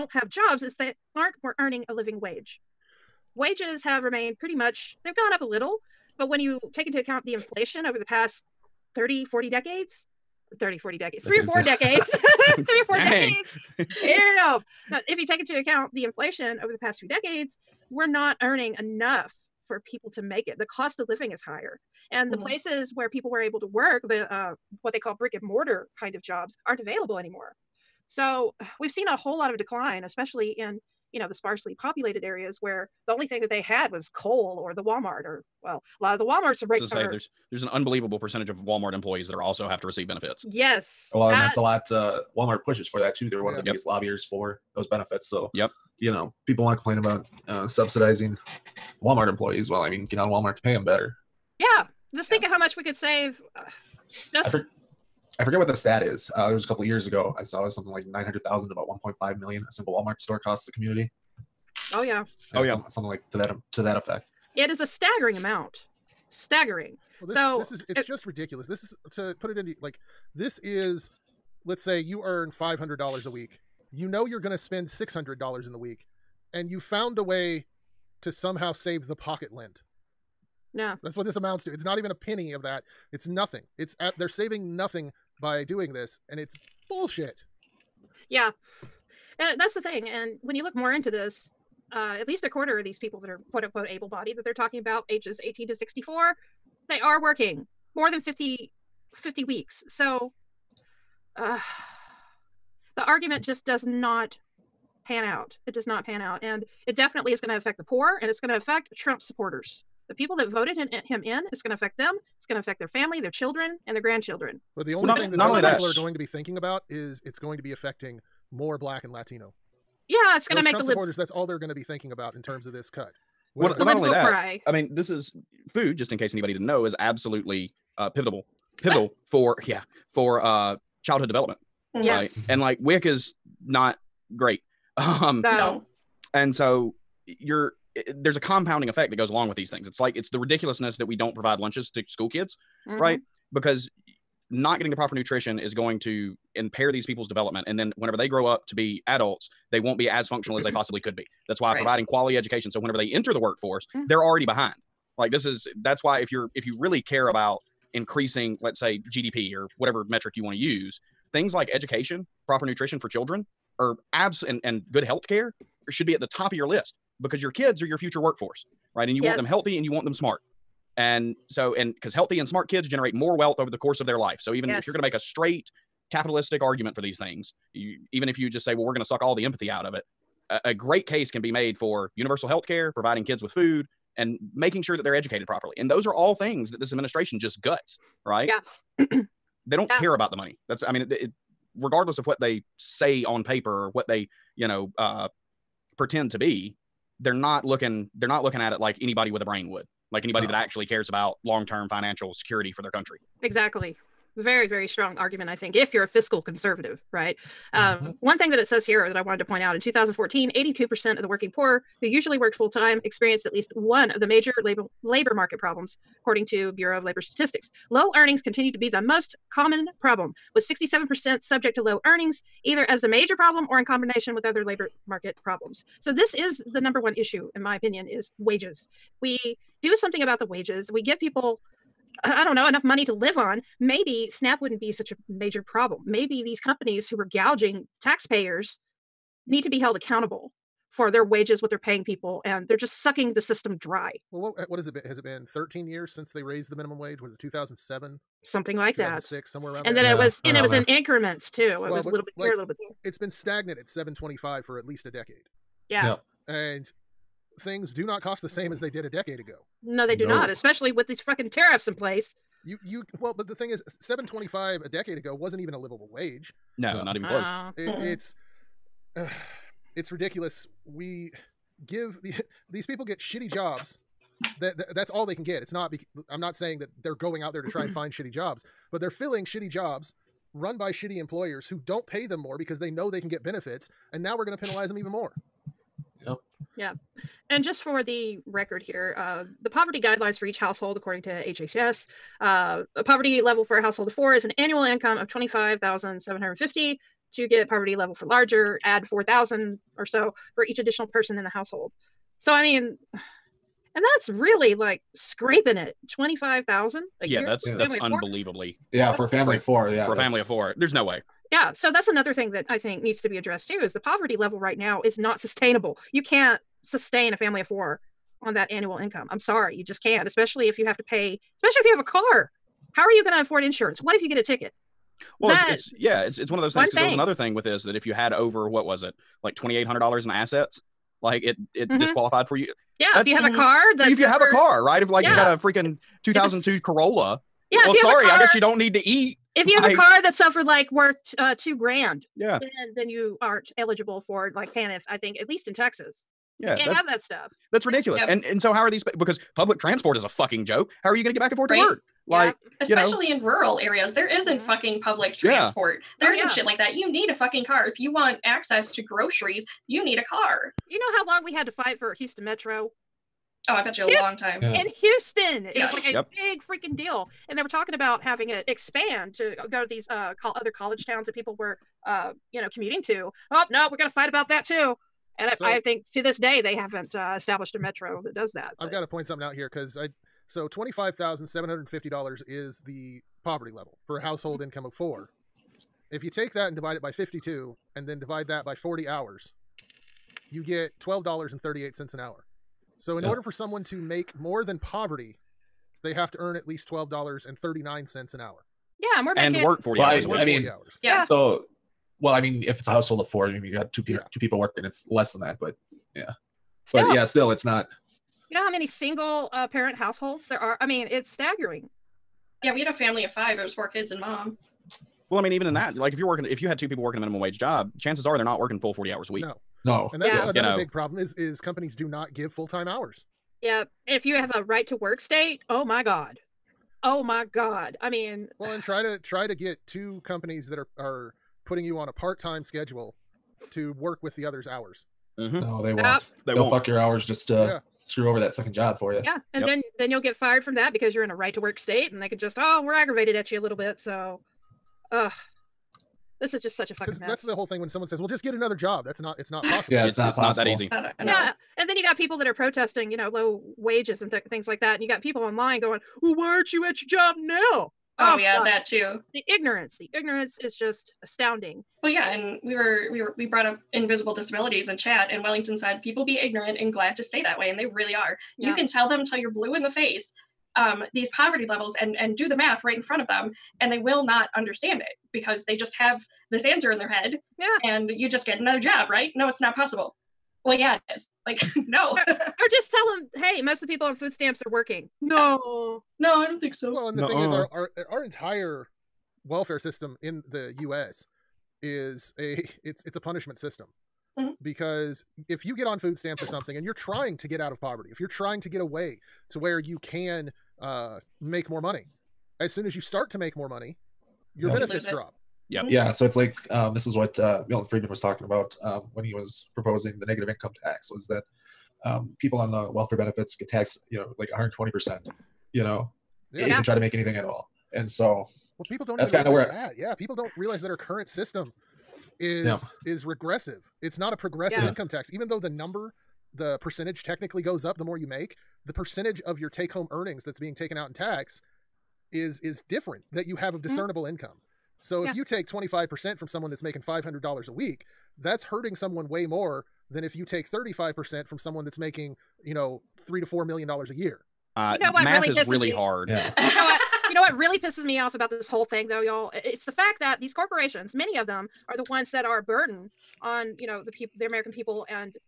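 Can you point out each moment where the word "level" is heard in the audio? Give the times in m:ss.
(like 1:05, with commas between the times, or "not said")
4:53, 4:57, 5:14, 6:23, 7:51.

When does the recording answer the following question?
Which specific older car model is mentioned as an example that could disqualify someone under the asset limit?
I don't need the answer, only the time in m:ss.
5:36.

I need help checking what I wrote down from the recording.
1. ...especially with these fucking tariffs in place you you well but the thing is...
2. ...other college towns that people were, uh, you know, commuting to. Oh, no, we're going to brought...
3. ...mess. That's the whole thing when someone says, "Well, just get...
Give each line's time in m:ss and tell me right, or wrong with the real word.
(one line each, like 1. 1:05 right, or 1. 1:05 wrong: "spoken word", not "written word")
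1. 4:20 right
2. 6:10 wrong: "fight", not "brought"
3. 7:27 right.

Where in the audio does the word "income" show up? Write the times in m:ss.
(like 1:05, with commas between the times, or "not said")
4:54, 5:18, 6:24, 8:30, 8:44, 8:54.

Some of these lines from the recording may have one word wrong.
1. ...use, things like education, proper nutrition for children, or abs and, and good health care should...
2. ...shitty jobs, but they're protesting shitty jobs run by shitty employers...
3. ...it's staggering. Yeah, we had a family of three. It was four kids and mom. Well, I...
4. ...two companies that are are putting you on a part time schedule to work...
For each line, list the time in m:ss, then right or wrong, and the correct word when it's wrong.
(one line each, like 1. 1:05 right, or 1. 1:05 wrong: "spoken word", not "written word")
1. 2:40 right
2. 4:38 wrong: "filling", not "protesting"
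3. 6:51 wrong: "five", not "three"
4. 7:09 right.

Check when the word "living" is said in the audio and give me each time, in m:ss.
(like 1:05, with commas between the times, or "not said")
0:01, 0:21.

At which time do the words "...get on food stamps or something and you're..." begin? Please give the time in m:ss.
8:15.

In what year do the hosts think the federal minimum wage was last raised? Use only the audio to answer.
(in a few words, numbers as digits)
2007.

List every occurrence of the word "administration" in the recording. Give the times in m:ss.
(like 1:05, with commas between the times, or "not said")
3:06.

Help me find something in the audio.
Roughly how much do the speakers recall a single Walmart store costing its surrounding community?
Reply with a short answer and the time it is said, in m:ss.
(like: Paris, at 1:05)
1.5 million, at 0:58.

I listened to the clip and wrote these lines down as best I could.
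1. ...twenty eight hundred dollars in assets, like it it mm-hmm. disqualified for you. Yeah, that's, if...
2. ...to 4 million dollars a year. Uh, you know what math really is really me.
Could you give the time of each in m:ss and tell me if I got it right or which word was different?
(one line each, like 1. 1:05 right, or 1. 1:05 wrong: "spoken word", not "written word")
1. 5:29 right
2. 9:03 right.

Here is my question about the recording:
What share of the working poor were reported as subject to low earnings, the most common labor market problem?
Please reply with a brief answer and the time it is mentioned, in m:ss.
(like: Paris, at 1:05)
67%, at 3:40.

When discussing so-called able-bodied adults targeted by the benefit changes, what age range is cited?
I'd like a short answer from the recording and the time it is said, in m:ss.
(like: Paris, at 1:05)
18 to 64, at 1:35.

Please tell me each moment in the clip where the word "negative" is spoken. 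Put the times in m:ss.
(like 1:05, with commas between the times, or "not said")
8:30.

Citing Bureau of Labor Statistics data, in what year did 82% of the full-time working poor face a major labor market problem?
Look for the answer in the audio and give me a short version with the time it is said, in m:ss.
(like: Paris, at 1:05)
2014, at 3:29.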